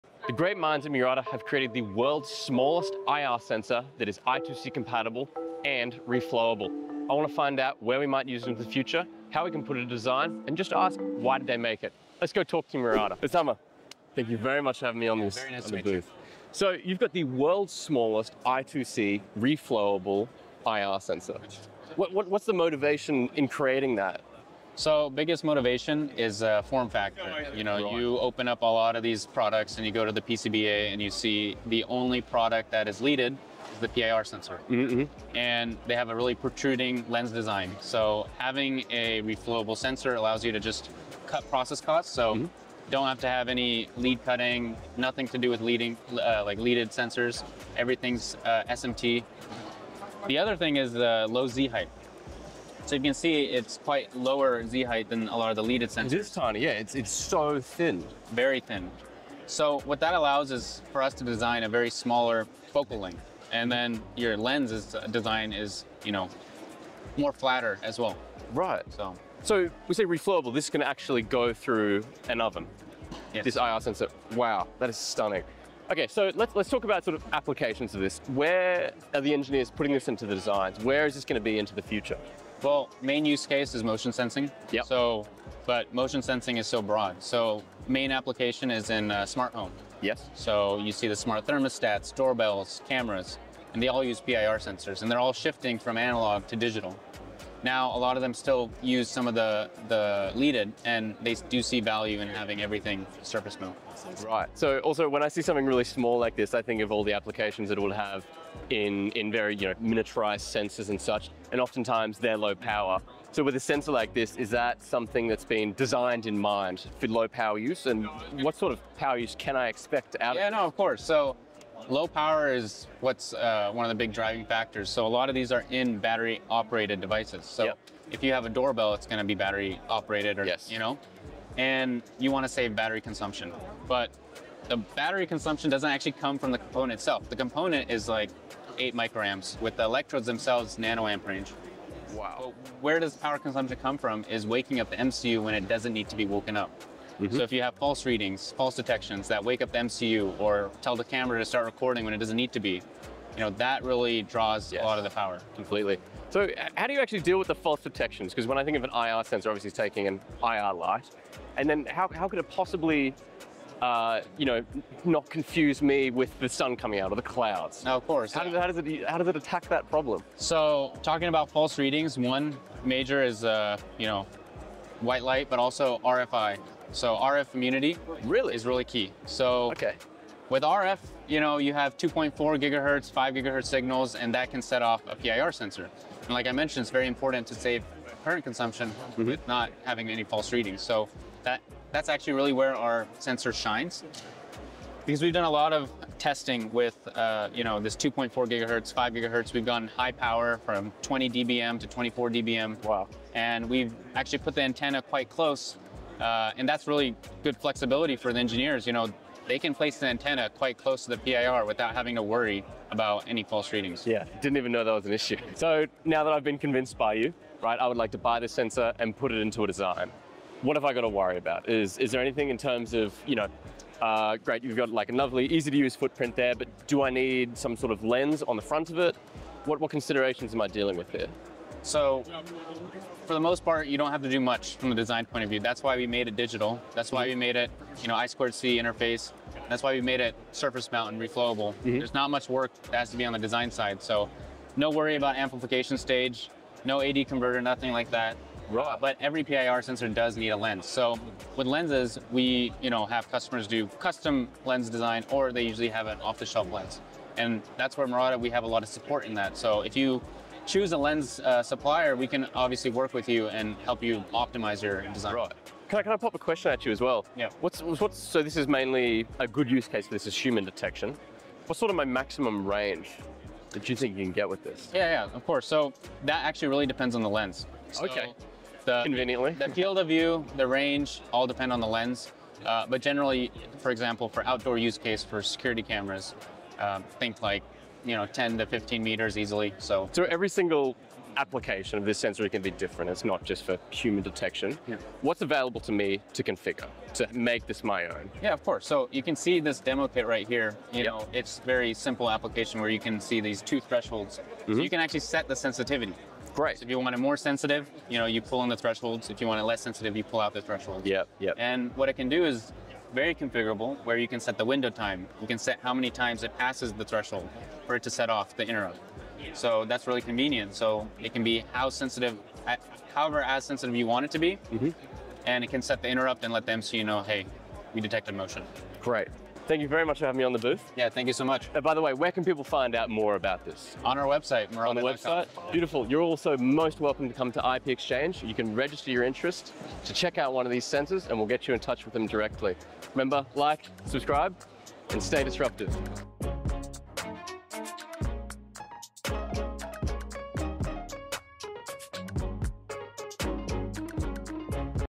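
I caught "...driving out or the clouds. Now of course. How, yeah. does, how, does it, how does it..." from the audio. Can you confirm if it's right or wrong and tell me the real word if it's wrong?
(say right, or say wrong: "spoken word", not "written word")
wrong: "coming", not "driving".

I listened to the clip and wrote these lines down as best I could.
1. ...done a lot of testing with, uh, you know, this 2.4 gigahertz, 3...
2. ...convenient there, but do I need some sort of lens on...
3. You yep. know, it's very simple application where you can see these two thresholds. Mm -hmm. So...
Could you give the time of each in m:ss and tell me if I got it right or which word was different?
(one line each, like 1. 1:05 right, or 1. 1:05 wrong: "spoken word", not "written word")
1. 3:15 wrong: "5", not "3"
2. 3:45 wrong: "footprint", not "convenient"
3. 5:00 right.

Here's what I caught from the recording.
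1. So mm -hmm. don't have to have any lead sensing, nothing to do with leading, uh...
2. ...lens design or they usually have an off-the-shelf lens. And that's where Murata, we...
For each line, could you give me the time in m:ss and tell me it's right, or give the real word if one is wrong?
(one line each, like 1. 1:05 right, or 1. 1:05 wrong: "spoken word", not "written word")
1. 0:42 wrong: "cutting", not "sensing"
2. 4:14 right.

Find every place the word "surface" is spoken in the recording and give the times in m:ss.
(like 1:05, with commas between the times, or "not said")
1:43, 4:00.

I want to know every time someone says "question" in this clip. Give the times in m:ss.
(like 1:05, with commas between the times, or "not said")
4:26.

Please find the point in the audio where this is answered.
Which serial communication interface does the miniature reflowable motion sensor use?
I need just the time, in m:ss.
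3:58.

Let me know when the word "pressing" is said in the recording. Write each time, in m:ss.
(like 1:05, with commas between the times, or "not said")
not said.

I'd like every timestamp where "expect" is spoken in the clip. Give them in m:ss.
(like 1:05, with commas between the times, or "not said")
1:59.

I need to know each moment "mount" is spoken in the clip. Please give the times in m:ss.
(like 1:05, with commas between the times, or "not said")
1:43, 4:00.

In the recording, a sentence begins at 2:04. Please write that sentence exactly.
So a lot of these are in battery operated devices.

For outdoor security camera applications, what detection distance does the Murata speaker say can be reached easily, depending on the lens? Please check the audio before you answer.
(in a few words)
10 to 15 meters.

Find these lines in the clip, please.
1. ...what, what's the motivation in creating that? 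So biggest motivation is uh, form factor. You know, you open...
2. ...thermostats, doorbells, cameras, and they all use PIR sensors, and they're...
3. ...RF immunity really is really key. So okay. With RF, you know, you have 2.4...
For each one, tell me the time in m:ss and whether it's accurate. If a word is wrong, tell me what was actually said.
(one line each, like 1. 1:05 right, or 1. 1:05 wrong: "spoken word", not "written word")
1. 0:22 right
2. 1:31 right
3. 2:57 right.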